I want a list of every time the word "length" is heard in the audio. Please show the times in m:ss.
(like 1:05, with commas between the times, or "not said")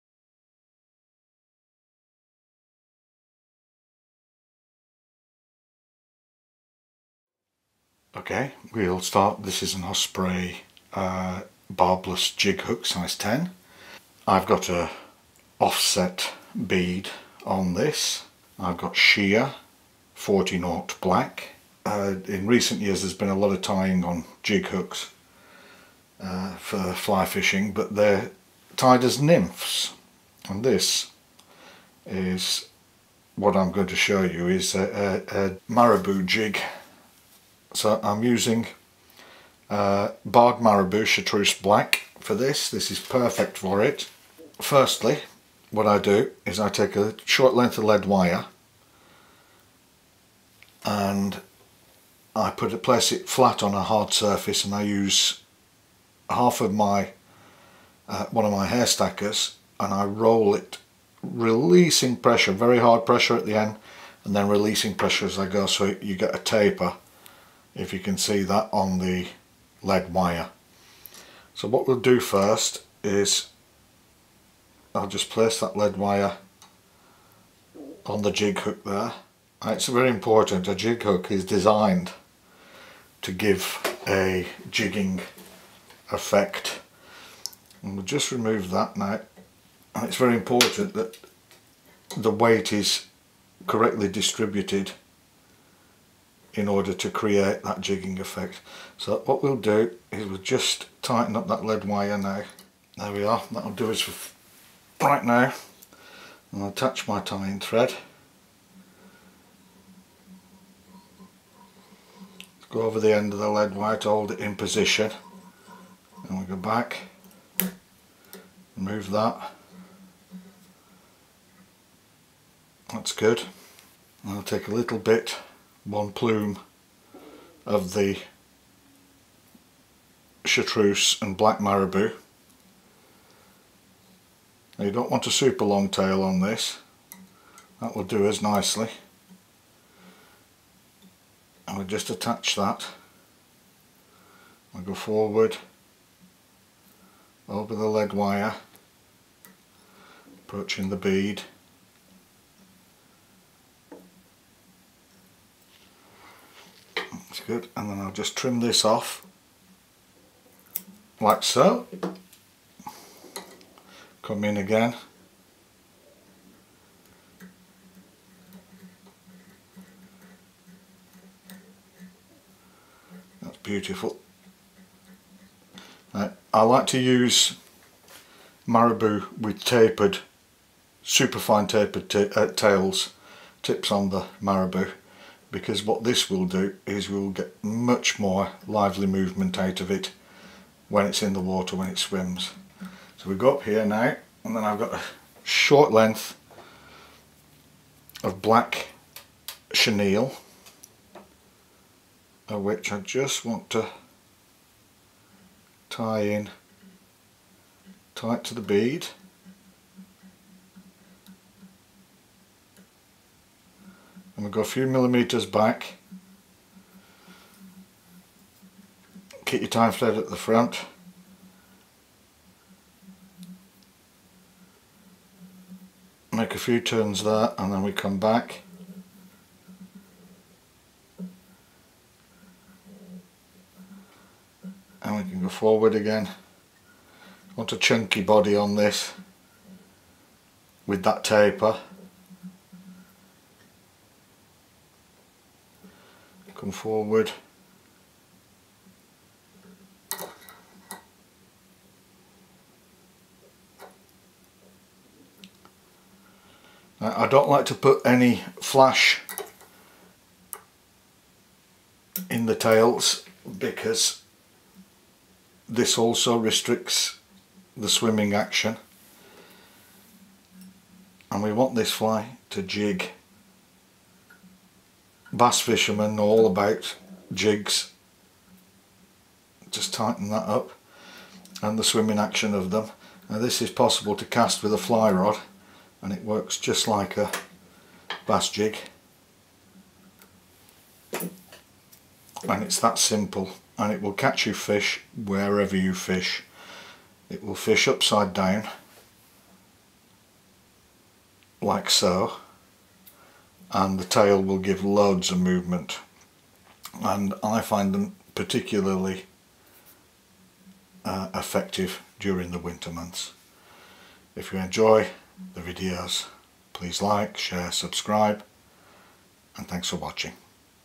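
0:47, 3:15.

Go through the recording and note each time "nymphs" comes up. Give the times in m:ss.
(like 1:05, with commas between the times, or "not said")
0:29.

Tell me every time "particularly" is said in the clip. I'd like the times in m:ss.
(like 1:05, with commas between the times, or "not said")
5:08.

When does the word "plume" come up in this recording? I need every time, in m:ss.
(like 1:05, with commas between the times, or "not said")
2:06.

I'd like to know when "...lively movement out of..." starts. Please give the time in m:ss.
3:08.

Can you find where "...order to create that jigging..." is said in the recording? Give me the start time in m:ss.
1:36.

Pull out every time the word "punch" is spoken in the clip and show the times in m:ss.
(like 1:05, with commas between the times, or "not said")
not said.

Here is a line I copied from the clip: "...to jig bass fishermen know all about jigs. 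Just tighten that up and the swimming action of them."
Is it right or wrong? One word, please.
right.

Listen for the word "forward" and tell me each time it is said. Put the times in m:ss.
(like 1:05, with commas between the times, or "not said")
2:24, 3:55, 4:06.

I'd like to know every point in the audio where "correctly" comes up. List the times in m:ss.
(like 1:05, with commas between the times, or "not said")
1:33.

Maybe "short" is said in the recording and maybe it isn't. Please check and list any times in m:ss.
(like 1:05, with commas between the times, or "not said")
0:47, 3:15.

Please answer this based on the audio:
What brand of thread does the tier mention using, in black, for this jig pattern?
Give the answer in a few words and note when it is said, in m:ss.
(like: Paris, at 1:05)
Sheer 40, at 0:18.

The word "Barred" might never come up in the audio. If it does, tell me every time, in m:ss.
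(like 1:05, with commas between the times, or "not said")
0:40.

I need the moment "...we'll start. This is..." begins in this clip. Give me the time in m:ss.
0:08.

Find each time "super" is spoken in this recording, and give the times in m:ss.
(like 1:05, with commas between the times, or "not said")
2:15, 3:01.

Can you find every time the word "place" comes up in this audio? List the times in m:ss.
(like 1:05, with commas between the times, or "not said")
0:52, 1:15.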